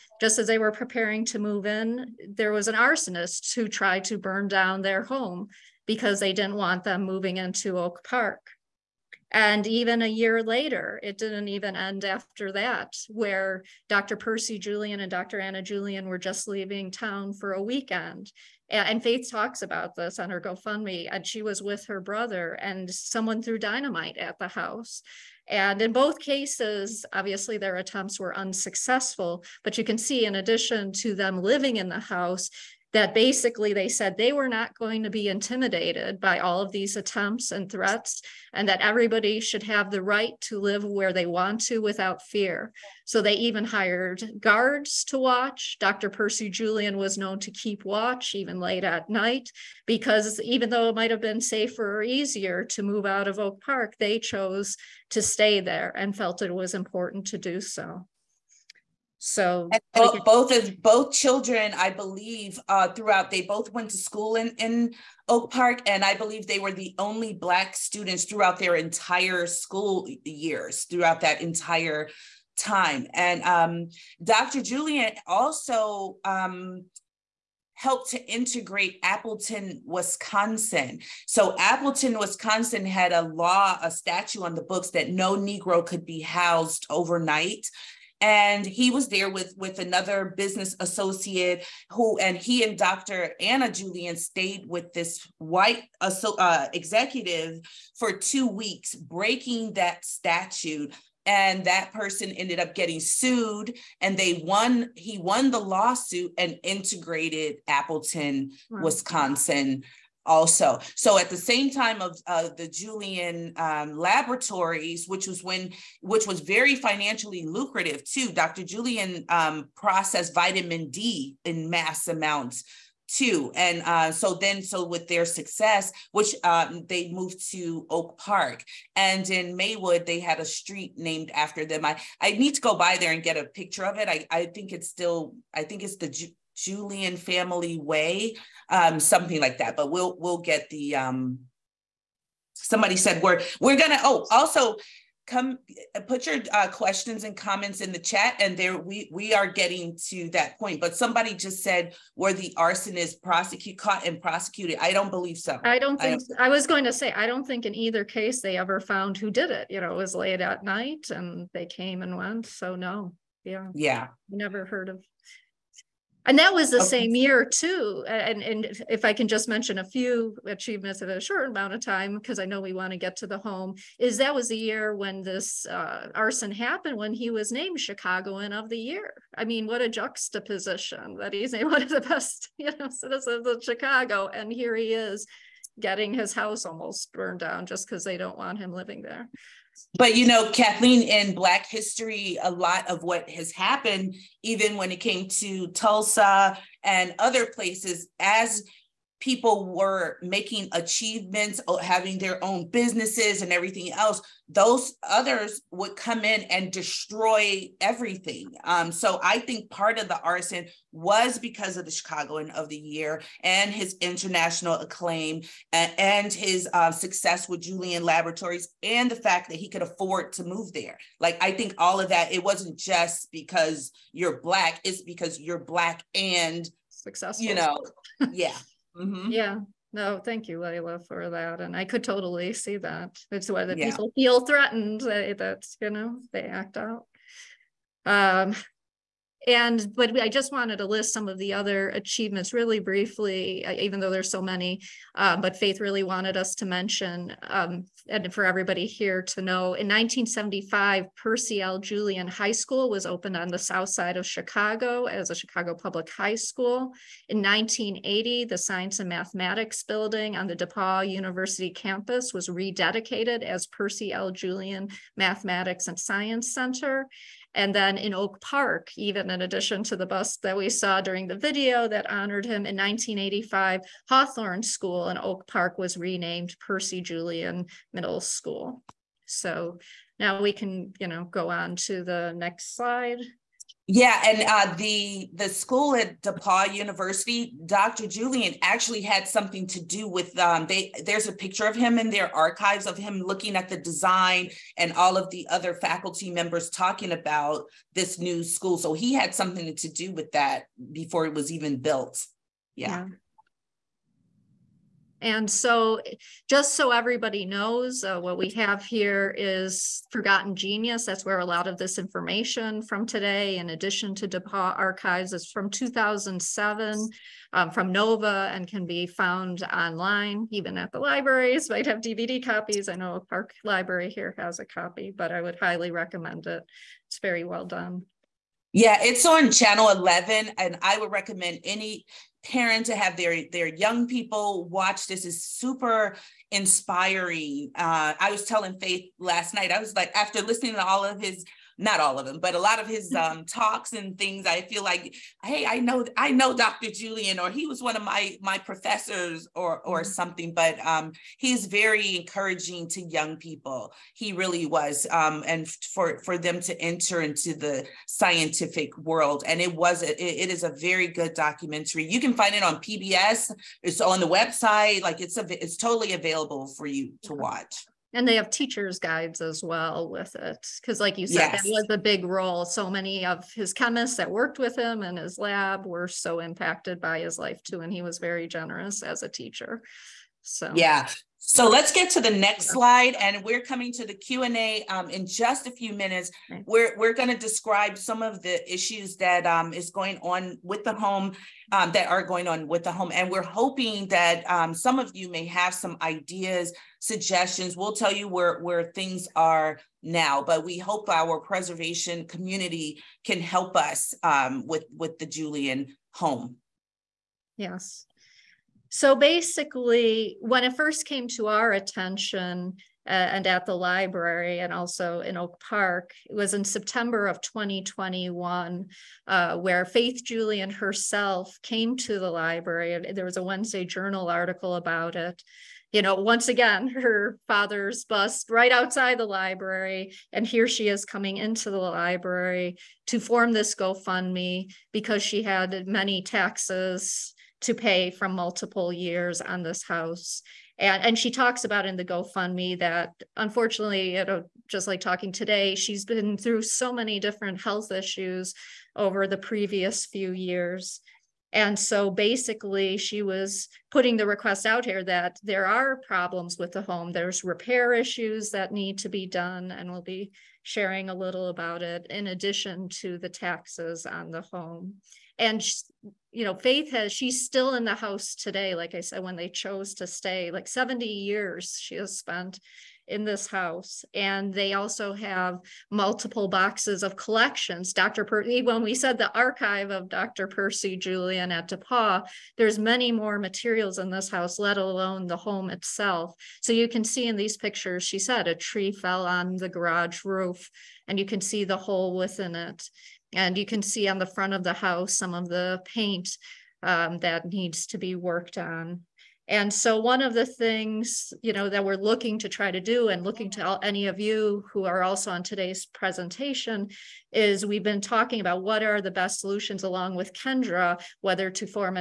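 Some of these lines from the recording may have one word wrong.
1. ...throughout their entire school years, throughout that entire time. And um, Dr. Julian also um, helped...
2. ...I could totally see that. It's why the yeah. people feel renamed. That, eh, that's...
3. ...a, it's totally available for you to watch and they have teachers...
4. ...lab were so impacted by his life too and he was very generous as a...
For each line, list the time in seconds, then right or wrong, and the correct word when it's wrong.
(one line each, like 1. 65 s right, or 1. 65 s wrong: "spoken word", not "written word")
1. 68 s right
2. 231 s wrong: "threatened", not "renamed"
3. 365 s right
4. 375 s right.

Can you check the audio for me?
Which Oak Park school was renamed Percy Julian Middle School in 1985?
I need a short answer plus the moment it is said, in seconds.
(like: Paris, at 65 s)
Hawthorne School, at 274 s.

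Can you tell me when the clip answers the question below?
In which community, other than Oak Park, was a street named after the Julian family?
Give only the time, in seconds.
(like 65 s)
129 s.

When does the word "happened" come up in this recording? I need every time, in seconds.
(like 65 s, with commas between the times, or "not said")
176 s, 193 s.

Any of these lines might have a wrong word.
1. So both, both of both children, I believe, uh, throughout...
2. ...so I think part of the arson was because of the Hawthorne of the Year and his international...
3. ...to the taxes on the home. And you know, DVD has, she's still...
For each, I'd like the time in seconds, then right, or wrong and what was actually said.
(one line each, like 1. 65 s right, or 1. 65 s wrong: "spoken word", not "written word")
1. 59 s right
2. 208 s wrong: "Chicagoan", not "Hawthorne"
3. 462 s wrong: "Faith", not "DVD".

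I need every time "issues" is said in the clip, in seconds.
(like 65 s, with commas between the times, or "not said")
388 s, 447 s, 457 s.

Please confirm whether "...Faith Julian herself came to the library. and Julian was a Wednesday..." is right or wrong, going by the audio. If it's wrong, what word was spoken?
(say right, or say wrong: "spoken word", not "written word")
wrong: "There", not "Julian".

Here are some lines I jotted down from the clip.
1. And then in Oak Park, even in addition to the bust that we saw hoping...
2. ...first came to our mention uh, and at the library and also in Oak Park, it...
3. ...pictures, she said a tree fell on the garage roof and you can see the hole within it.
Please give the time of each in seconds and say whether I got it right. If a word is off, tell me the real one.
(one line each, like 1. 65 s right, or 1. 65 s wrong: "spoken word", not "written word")
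1. 267 s wrong: "during", not "hoping"
2. 410 s wrong: "attention", not "mention"
3. 487 s right.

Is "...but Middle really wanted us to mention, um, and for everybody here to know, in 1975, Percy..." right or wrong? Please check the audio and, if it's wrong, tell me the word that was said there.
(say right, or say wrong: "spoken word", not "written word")
wrong: "Faith", not "Middle".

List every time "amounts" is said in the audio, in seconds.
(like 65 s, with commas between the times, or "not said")
122 s, 171 s.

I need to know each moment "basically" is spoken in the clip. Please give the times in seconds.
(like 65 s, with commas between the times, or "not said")
33 s, 409 s, 452 s.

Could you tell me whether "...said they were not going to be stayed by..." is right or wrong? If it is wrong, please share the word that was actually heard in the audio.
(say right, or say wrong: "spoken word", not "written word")
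wrong: "intimidated", not "stayed".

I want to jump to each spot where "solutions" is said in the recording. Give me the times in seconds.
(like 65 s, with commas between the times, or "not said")
509 s.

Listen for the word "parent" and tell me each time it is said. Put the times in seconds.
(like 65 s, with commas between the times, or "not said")
332 s.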